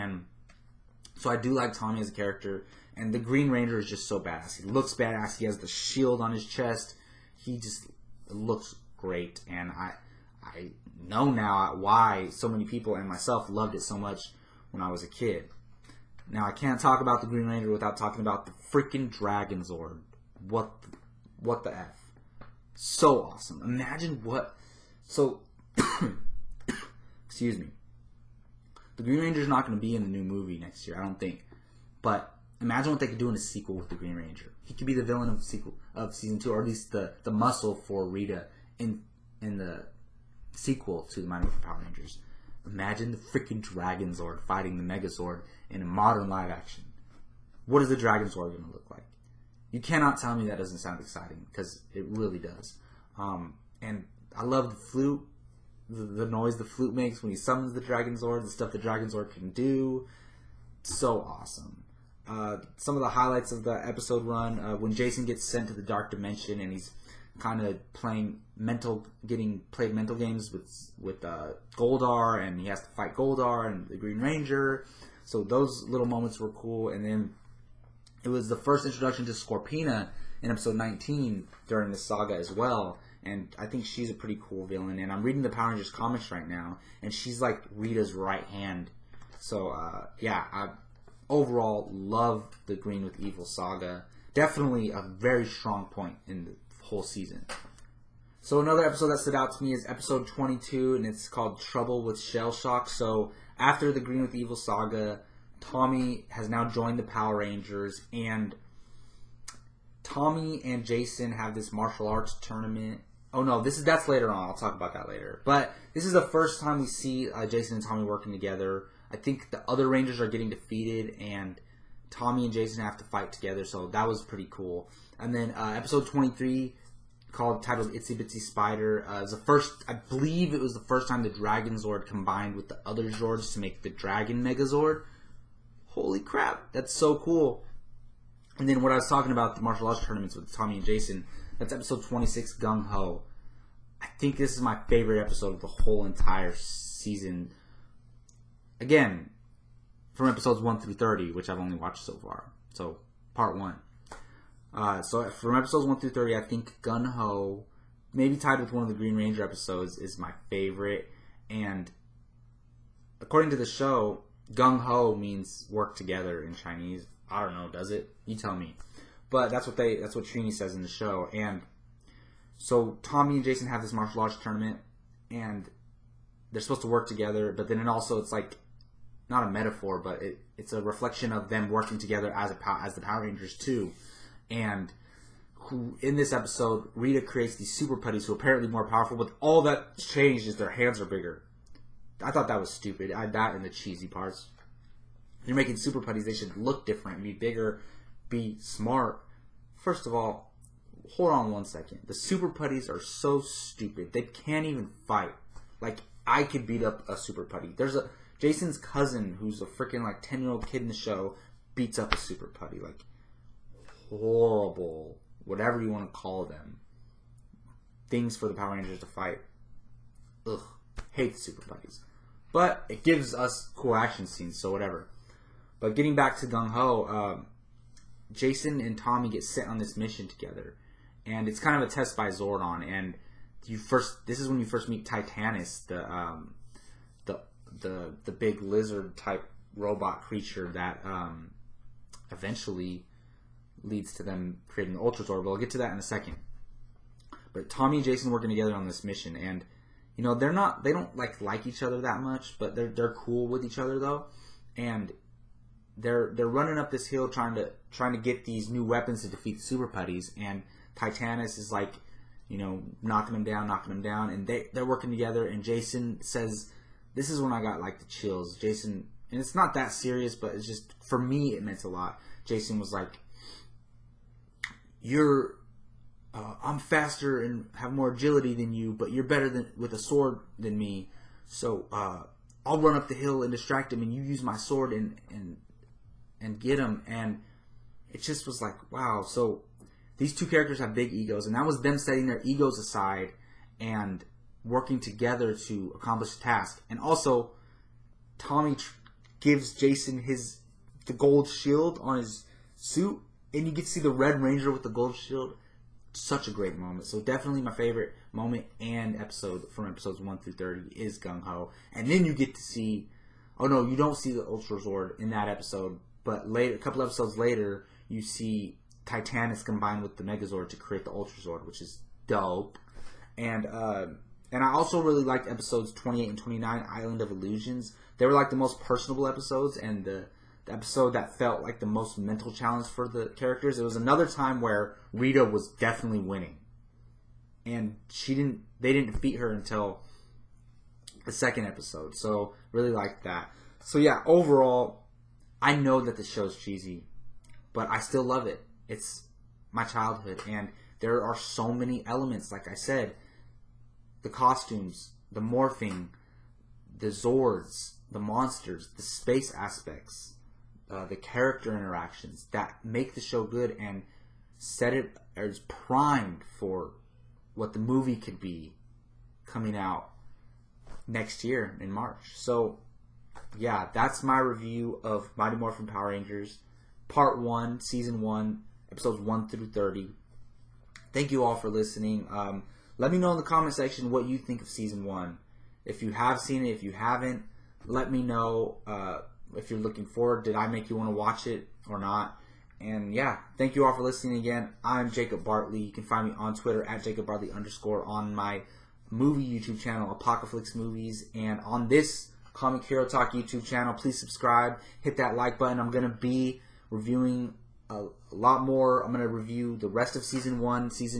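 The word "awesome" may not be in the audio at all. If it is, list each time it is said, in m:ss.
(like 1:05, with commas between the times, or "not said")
0:23, 1:01.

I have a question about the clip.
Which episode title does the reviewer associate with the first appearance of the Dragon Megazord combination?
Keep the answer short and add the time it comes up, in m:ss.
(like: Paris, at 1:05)
Itsy Bitsy Spider, at 2:07.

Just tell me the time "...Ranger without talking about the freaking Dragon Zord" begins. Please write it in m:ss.
0:17.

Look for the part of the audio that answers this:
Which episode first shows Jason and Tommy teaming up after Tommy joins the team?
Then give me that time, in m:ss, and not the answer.
1:41.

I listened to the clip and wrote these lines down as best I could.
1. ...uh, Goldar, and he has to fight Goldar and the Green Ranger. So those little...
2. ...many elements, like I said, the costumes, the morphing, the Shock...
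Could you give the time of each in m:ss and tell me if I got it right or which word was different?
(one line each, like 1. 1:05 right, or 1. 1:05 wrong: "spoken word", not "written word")
1. 1:11 right
2. 5:51 wrong: "Zords", not "Shock".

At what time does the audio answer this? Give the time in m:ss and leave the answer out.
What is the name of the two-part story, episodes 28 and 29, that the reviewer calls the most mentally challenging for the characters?
5:26.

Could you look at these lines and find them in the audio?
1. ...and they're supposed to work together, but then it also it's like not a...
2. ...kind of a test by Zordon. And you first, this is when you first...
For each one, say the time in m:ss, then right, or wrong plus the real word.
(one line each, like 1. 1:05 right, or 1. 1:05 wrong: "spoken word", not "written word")
1. 2:55 right
2. 3:51 right.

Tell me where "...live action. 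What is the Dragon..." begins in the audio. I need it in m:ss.
0:46.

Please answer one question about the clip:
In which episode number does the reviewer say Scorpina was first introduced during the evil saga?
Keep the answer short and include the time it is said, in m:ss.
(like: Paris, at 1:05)
19, at 1:20.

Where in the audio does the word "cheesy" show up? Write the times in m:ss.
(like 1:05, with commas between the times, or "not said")
3:13, 5:46.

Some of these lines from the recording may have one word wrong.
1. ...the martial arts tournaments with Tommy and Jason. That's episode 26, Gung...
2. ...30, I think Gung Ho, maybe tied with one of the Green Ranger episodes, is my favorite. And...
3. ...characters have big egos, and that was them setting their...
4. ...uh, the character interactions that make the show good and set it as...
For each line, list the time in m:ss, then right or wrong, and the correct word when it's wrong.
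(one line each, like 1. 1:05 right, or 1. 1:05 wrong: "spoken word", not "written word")
1. 2:19 right
2. 2:36 right
3. 4:50 right
4. 6:00 right.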